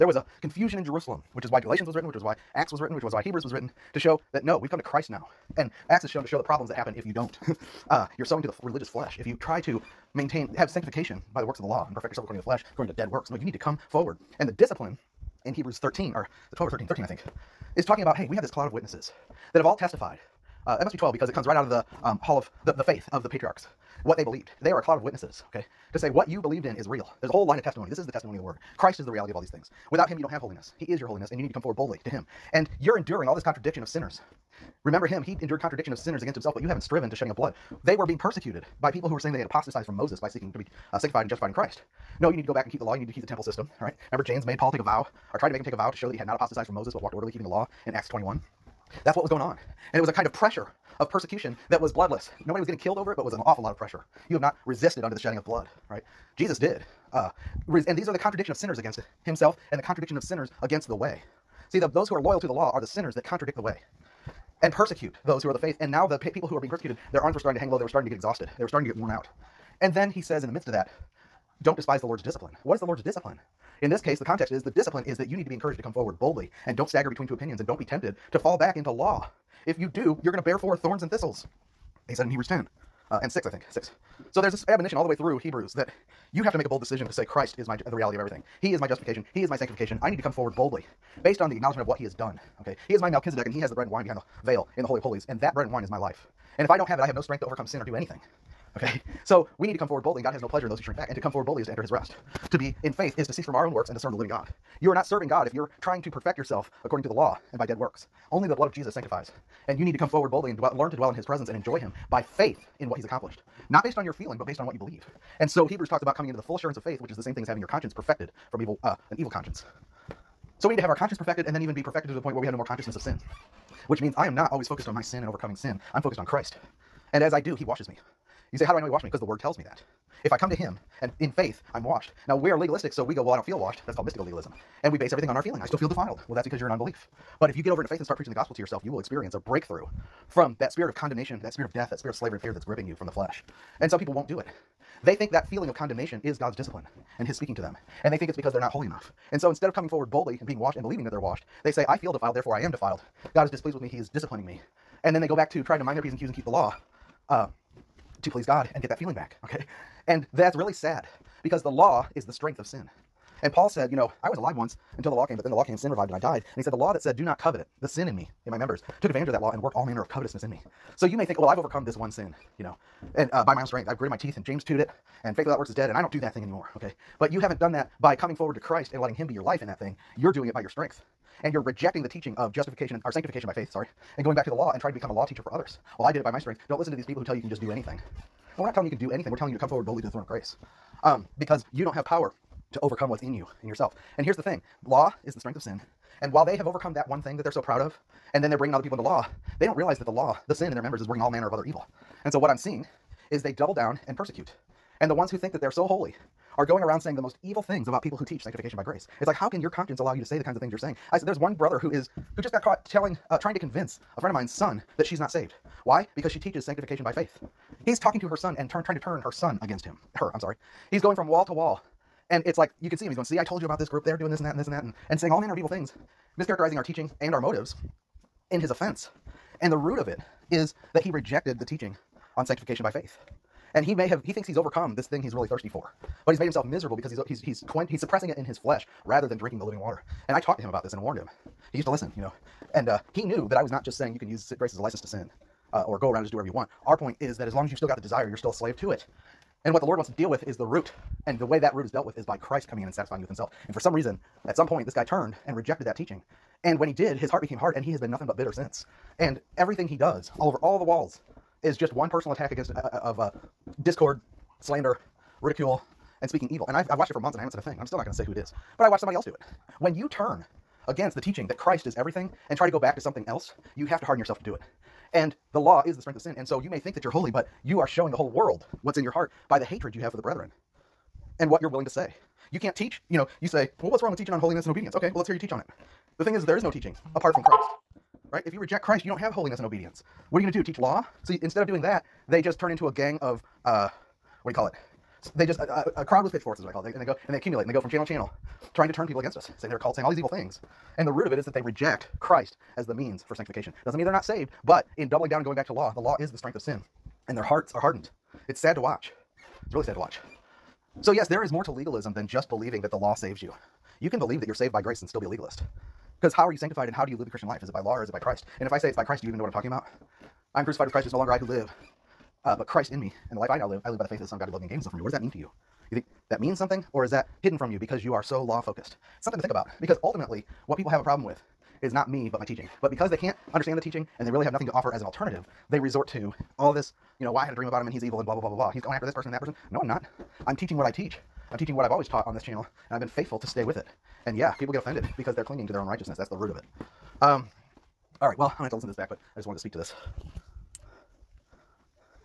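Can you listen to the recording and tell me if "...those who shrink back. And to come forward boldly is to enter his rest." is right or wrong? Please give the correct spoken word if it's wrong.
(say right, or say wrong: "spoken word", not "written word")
right.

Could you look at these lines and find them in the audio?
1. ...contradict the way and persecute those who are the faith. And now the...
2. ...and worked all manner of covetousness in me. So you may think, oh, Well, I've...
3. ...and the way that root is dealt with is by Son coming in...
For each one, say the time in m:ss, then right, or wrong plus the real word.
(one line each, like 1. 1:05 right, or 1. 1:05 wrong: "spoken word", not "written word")
1. 1:03 right
2. 2:49 right
3. 4:11 wrong: "Christ", not "Son".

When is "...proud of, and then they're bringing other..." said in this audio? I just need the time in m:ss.
3:17.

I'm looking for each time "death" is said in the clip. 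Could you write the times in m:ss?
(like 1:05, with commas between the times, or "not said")
2:21.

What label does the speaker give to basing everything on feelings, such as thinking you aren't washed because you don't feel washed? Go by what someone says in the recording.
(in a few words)
Mystical legalism.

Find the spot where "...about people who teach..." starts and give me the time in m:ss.
3:27.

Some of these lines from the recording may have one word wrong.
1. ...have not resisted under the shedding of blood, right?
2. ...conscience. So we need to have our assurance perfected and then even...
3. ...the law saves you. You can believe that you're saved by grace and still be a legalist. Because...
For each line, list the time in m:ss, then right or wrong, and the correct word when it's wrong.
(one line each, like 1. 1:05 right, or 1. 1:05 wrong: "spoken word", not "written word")
1. 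0:54 right
2. 1:59 wrong: "conscience", not "assurance"
3. 5:12 right.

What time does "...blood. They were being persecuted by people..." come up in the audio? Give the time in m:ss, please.
0:37.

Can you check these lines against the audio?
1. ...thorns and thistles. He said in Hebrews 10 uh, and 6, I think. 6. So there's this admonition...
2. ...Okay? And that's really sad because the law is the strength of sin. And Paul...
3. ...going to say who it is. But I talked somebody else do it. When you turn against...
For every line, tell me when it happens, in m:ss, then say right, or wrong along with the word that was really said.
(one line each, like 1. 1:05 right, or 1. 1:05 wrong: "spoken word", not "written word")
1. 1:20 right
2. 2:39 right
3. 4:28 wrong: "watched", not "talked".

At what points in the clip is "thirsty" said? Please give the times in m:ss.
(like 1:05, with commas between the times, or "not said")
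3:55.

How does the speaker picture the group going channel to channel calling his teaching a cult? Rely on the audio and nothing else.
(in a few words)
A crowd with pitchforks.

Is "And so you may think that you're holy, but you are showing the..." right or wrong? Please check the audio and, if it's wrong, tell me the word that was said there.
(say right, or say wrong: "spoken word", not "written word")
right.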